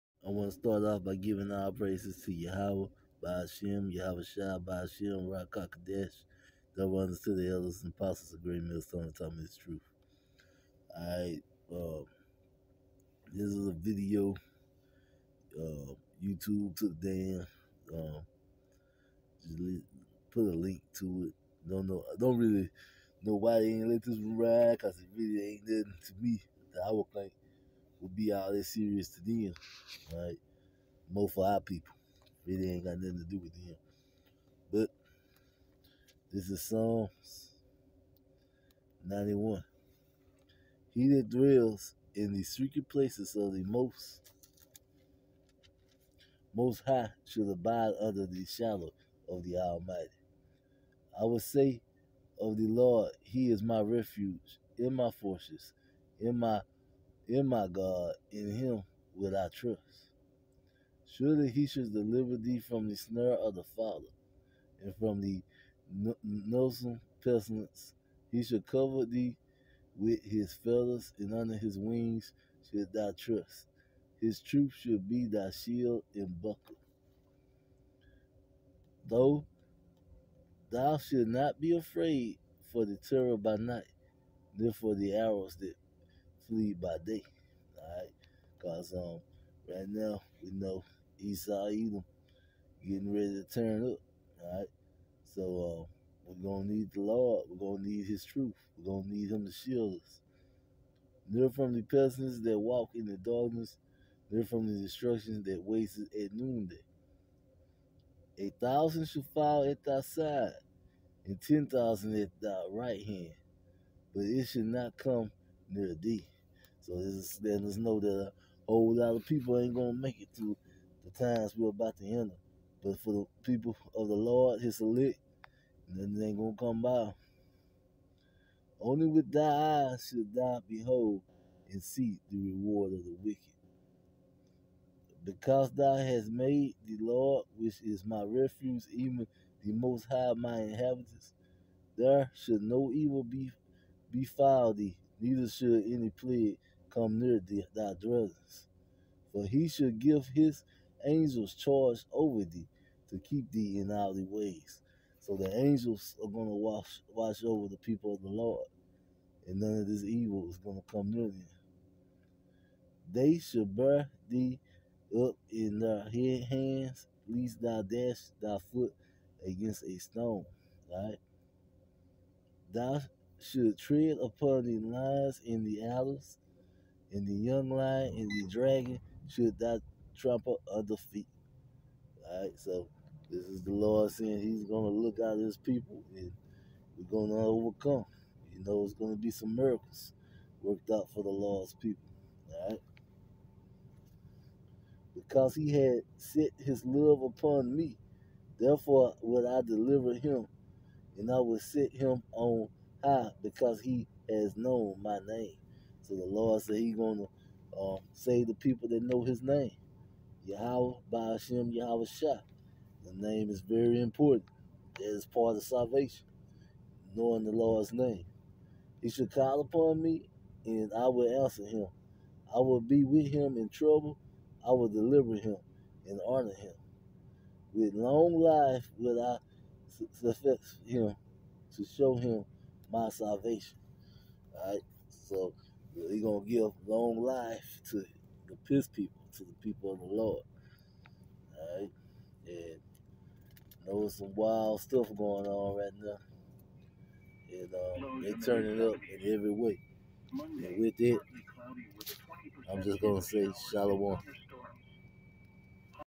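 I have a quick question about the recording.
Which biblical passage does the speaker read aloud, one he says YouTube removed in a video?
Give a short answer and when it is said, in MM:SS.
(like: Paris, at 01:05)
Psalms 91, at 00:36.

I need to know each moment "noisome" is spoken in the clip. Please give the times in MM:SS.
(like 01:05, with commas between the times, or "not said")
01:06.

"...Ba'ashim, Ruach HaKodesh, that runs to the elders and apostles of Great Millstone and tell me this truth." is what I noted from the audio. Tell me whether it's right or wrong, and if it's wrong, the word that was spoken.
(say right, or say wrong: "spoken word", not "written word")
right.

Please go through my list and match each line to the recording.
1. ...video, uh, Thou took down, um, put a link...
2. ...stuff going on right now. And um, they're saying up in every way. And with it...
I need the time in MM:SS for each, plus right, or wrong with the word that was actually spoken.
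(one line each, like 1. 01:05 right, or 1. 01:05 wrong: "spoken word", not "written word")
1. 00:13 wrong: "YouTube", not "Thou"
2. 04:04 wrong: "turning", not "saying".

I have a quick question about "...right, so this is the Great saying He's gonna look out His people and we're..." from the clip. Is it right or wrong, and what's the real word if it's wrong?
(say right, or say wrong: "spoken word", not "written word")
wrong: "Lord", not "Great".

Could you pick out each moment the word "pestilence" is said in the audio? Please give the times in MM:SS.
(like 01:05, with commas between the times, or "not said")
01:07, 01:41.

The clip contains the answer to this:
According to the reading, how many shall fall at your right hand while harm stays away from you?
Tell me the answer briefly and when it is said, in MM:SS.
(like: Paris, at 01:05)
10,000, at 01:51.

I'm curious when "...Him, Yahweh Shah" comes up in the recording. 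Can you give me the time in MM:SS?
03:31.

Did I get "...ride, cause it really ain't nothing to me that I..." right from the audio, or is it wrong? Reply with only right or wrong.
right.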